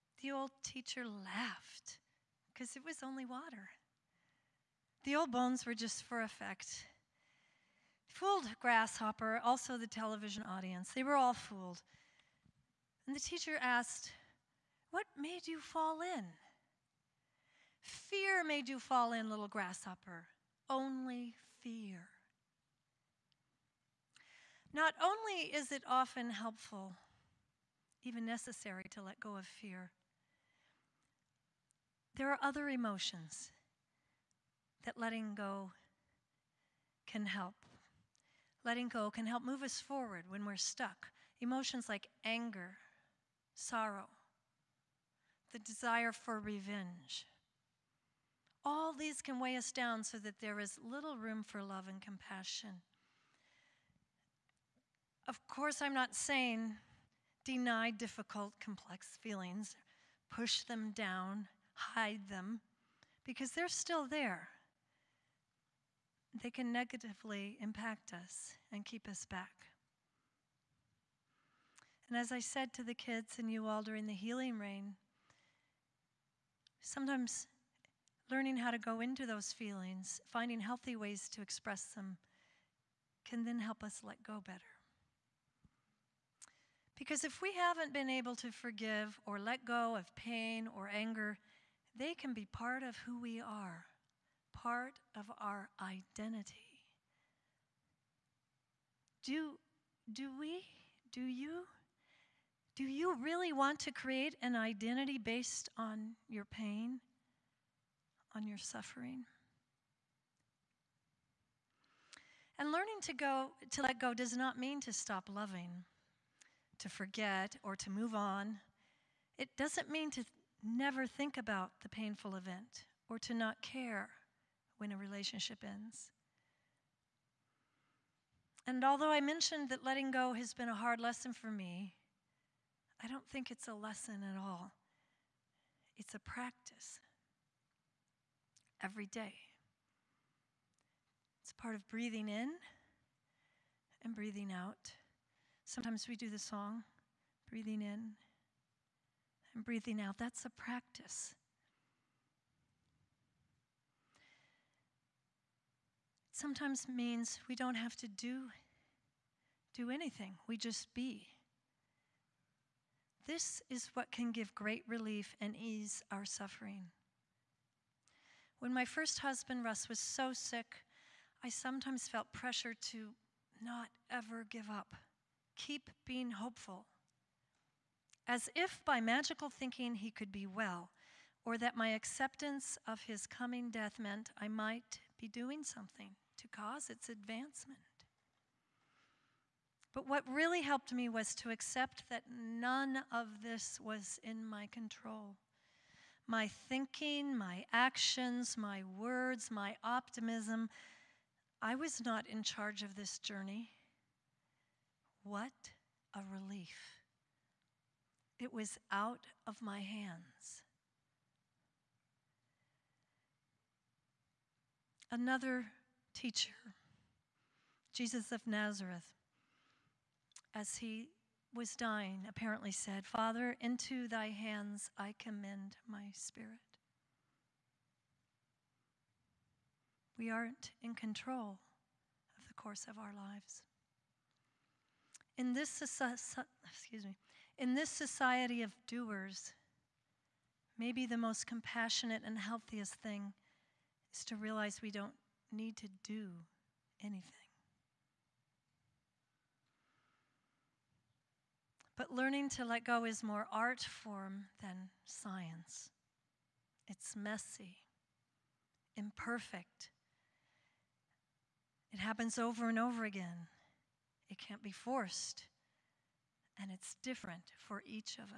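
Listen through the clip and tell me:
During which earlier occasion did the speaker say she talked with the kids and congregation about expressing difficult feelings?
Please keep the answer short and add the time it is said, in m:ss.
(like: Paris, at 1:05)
the healing rain, at 1:14.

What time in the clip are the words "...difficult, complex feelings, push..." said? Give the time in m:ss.
0:57.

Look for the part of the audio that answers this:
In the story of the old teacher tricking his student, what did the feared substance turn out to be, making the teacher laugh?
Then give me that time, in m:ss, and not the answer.
0:03.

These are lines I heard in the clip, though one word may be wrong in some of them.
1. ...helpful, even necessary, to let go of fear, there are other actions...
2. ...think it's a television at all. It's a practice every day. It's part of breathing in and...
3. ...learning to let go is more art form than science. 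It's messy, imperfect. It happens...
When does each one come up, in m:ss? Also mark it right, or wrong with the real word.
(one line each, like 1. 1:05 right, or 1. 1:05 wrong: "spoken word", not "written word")
1. 0:26 wrong: "emotions", not "actions"
2. 2:13 wrong: "lesson", not "television"
3. 4:12 right.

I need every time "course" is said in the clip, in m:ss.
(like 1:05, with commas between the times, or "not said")
0:55, 3:52.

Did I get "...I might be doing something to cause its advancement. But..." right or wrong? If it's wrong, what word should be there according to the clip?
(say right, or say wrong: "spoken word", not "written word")
right.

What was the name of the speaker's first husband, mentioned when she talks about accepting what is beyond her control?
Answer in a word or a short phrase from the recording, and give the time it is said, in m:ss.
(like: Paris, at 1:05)
Russ, at 2:49.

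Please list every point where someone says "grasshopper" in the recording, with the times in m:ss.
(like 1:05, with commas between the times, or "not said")
0:08, 0:19.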